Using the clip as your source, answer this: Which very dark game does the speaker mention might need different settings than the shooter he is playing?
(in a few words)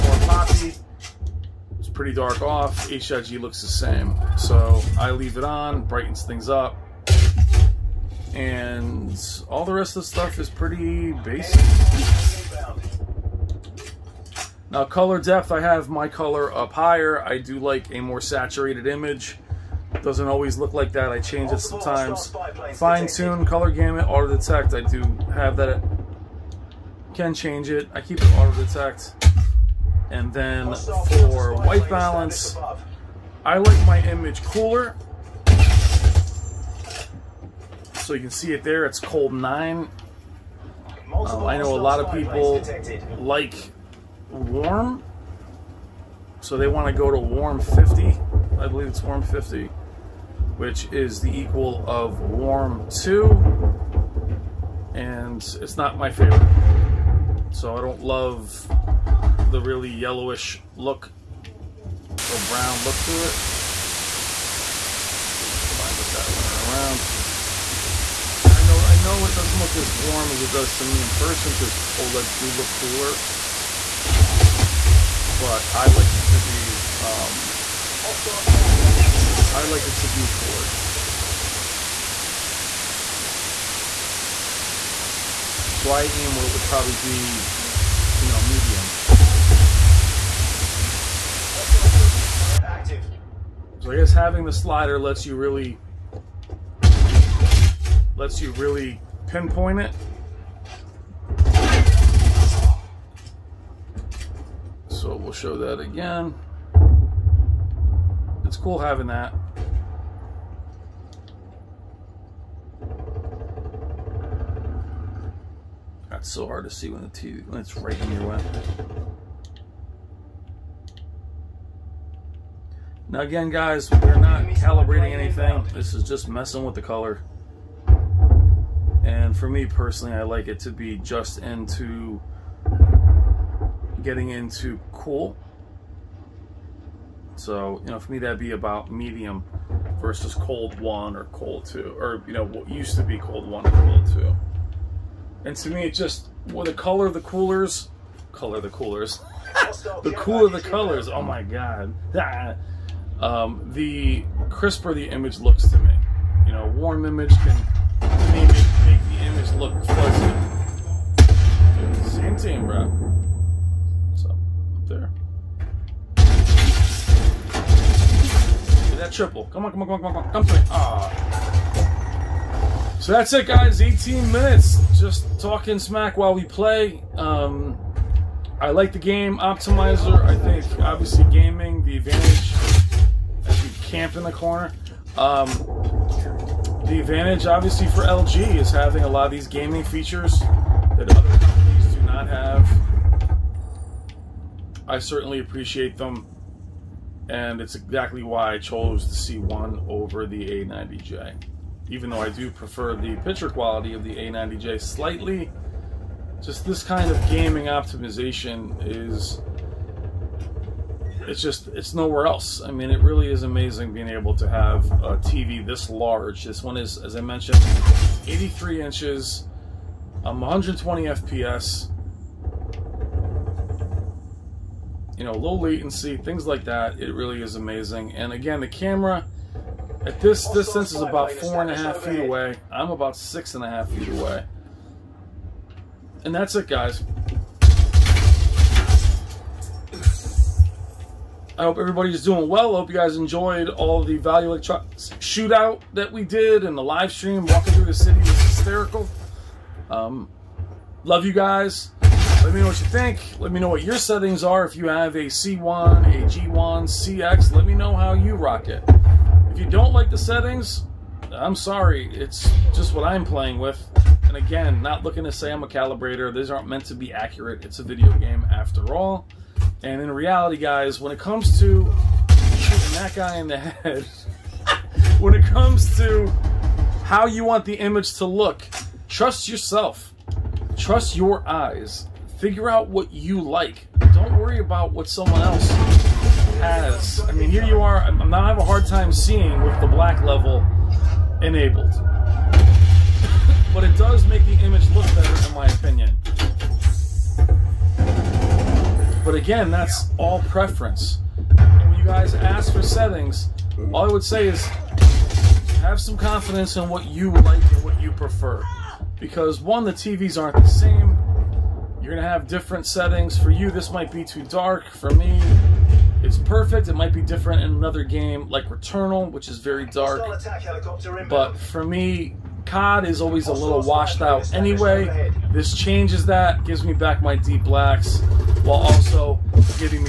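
Returnal.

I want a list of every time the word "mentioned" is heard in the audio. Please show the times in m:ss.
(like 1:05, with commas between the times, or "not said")
3:37.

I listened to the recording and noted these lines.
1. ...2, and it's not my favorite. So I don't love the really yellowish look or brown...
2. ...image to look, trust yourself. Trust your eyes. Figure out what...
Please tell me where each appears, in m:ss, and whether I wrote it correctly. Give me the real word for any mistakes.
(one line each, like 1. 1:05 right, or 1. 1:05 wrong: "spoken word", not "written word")
1. 0:52 right
2. 4:37 right.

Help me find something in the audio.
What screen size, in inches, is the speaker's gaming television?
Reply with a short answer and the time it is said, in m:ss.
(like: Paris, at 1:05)
83, at 3:38.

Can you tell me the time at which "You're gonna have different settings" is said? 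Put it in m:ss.
5:12.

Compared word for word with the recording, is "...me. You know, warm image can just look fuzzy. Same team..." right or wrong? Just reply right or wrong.
right.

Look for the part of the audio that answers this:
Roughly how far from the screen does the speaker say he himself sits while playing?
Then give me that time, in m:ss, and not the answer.
3:53.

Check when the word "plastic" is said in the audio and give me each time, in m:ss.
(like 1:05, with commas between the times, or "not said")
not said.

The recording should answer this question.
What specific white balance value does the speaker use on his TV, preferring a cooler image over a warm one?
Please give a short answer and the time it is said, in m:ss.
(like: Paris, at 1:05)
Cold 9, at 0:39.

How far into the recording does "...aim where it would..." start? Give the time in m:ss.
1:26.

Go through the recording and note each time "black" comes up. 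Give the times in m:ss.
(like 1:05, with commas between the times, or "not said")
4:49, 5:27.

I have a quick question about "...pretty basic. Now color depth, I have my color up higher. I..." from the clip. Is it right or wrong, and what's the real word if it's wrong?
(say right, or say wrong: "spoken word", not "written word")
right.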